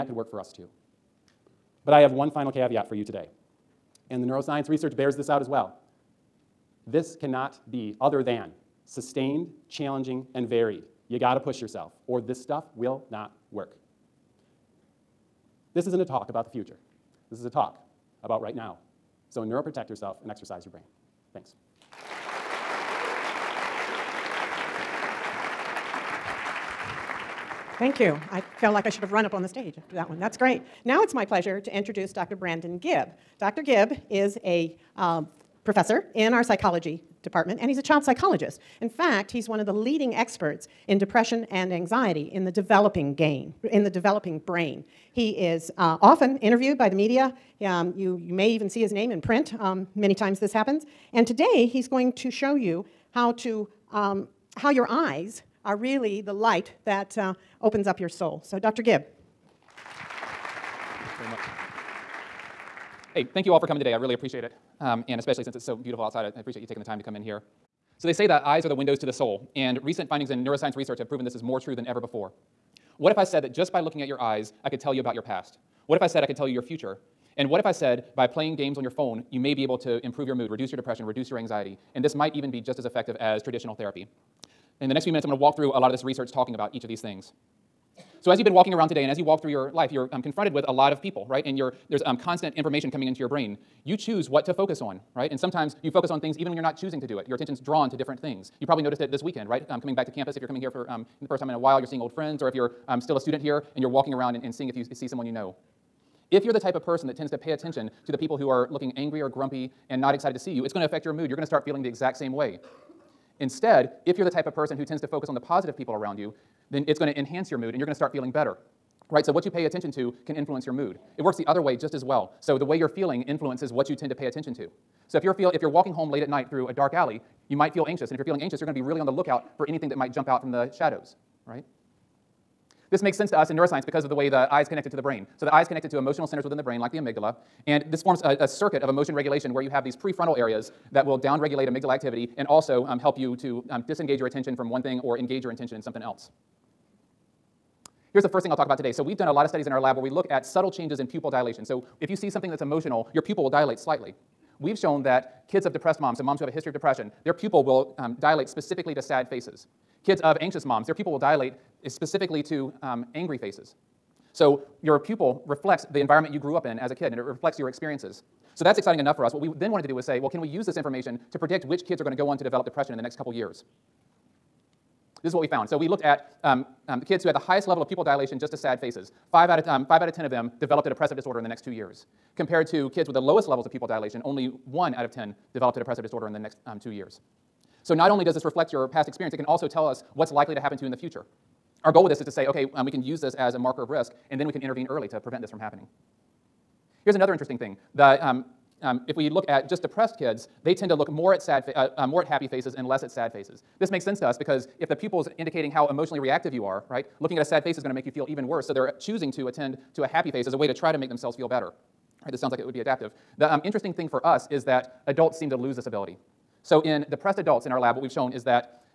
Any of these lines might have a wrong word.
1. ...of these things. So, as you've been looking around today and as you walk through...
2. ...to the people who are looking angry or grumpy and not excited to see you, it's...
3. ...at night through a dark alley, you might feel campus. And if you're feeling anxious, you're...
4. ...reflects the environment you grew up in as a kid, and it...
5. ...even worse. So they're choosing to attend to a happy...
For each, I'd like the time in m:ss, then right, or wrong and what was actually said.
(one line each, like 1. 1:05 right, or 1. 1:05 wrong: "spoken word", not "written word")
1. 1:26 wrong: "walking", not "looking"
2. 1:48 right
3. 2:06 wrong: "anxious", not "campus"
4. 2:45 right
5. 3:28 right.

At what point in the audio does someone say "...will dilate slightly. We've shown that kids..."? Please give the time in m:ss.
2:33.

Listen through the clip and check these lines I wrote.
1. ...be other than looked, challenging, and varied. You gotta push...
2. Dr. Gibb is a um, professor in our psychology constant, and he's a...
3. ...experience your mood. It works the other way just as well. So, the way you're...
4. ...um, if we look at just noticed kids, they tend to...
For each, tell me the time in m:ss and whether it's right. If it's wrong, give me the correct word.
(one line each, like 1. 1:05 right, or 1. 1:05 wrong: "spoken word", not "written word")
1. 0:07 wrong: "sustained", not "looked"
2. 0:33 wrong: "department", not "constant"
3. 2:00 wrong: "influence", not "experience"
4. 3:18 wrong: "depressed", not "noticed".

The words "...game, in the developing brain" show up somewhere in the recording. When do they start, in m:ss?
0:43.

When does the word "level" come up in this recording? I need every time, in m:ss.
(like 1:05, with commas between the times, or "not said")
2:57, 3:03.